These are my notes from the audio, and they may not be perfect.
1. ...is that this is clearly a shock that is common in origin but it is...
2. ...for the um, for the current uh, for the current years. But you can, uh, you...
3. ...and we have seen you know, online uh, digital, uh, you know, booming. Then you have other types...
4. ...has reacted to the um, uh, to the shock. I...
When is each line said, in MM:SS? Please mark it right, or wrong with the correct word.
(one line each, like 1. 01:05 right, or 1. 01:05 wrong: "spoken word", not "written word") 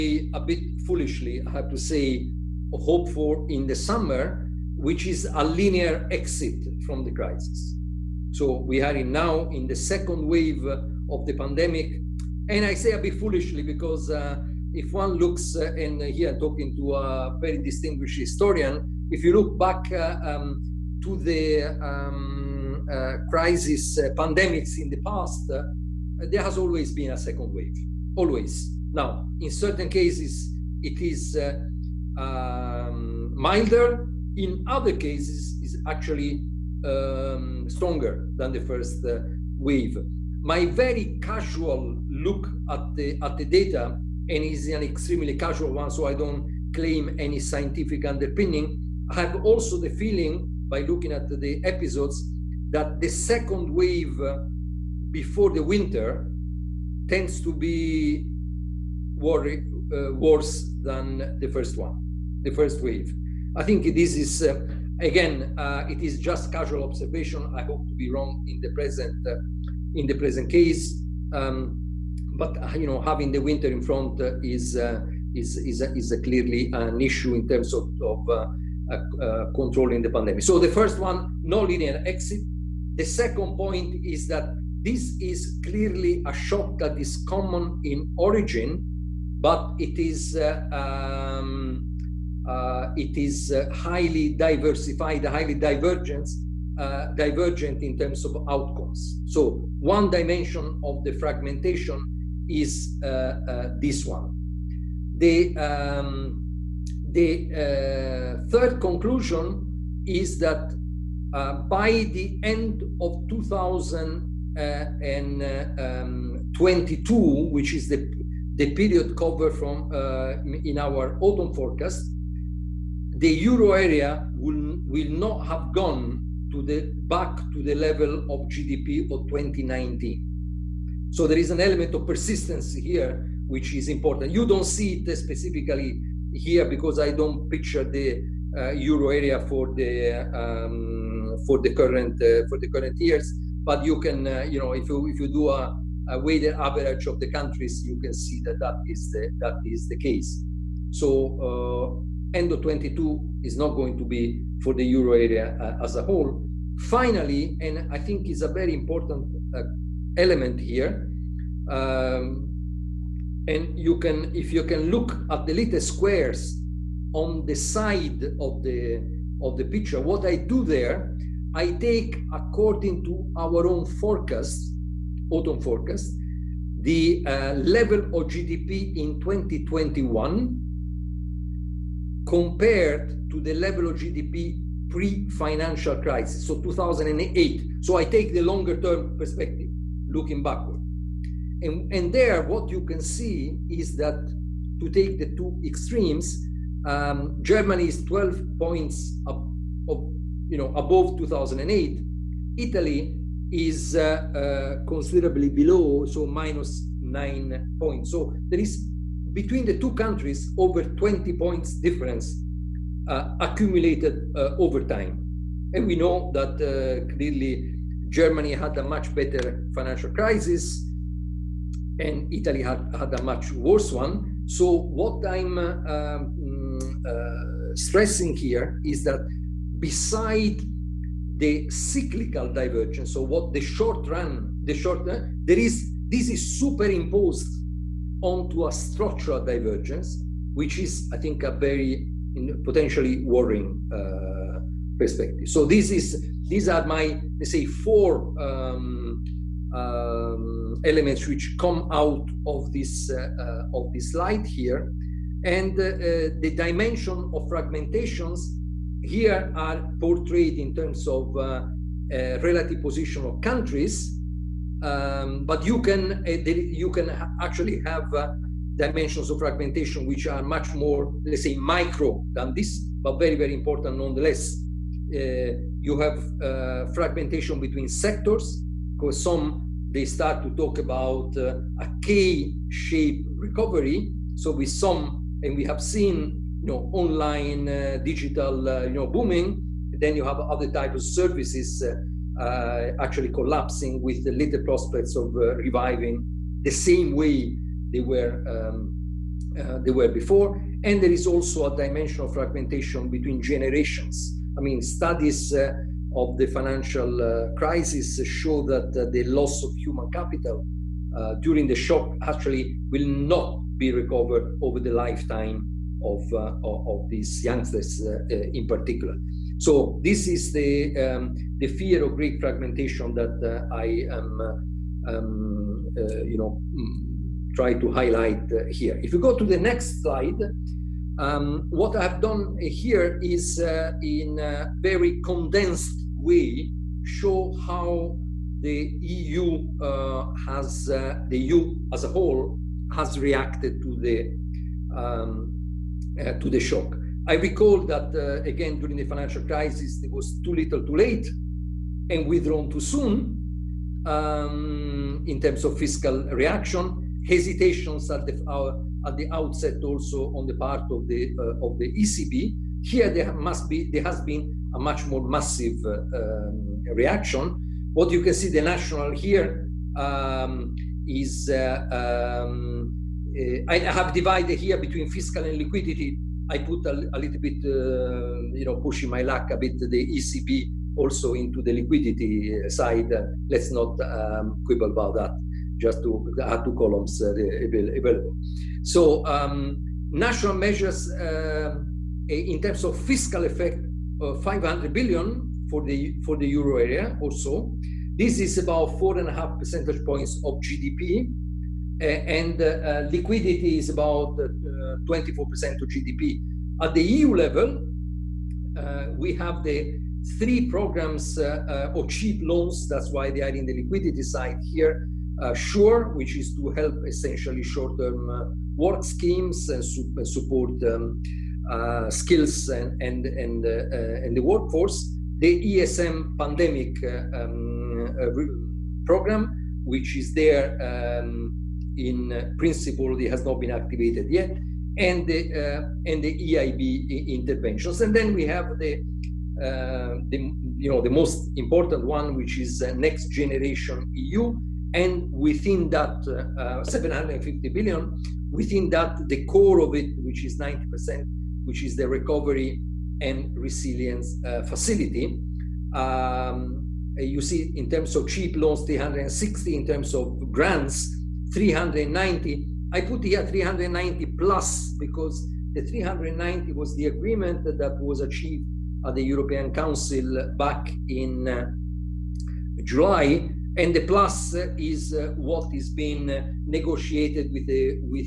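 1. 01:24 right
2. 02:19 right
3. 04:45 right
4. 05:42 right.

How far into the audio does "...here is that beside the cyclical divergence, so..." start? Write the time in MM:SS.
03:48.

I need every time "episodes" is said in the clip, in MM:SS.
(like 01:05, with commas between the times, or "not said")
00:51.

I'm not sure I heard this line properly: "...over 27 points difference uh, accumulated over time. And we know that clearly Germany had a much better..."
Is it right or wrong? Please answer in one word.
wrong.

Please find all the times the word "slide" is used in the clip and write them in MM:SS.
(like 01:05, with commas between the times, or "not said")
04:14, 05:30.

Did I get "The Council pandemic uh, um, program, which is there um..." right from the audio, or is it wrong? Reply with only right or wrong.
wrong.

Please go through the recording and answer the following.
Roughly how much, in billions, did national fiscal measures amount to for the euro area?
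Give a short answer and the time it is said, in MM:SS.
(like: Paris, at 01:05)
500 billion, at 06:34.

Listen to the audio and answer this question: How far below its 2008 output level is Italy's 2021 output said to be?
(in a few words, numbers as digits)
minus 9 points.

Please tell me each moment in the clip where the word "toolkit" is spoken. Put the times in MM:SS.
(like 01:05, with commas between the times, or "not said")
not said.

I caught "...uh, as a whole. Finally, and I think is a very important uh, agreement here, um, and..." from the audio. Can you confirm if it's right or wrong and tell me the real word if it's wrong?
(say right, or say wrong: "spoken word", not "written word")
wrong: "element", not "agreement".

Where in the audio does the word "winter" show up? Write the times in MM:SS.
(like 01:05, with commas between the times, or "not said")
00:55, 01:13.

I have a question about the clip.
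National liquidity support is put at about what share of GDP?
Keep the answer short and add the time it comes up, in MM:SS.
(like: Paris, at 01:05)
24%, at 06:45.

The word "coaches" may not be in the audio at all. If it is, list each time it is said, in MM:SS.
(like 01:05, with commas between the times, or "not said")
not said.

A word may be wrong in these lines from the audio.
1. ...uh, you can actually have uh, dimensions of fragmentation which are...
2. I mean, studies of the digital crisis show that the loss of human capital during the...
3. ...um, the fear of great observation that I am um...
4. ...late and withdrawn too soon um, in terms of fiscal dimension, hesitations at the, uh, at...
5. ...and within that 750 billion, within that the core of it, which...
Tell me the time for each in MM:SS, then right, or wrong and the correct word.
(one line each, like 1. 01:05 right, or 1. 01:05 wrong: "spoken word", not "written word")
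1. 04:26 right
2. 05:04 wrong: "financial", not "digital"
3. 05:20 wrong: "fragmentation", not "observation"
4. 05:50 wrong: "reaction", not "dimension"
5. 07:24 right.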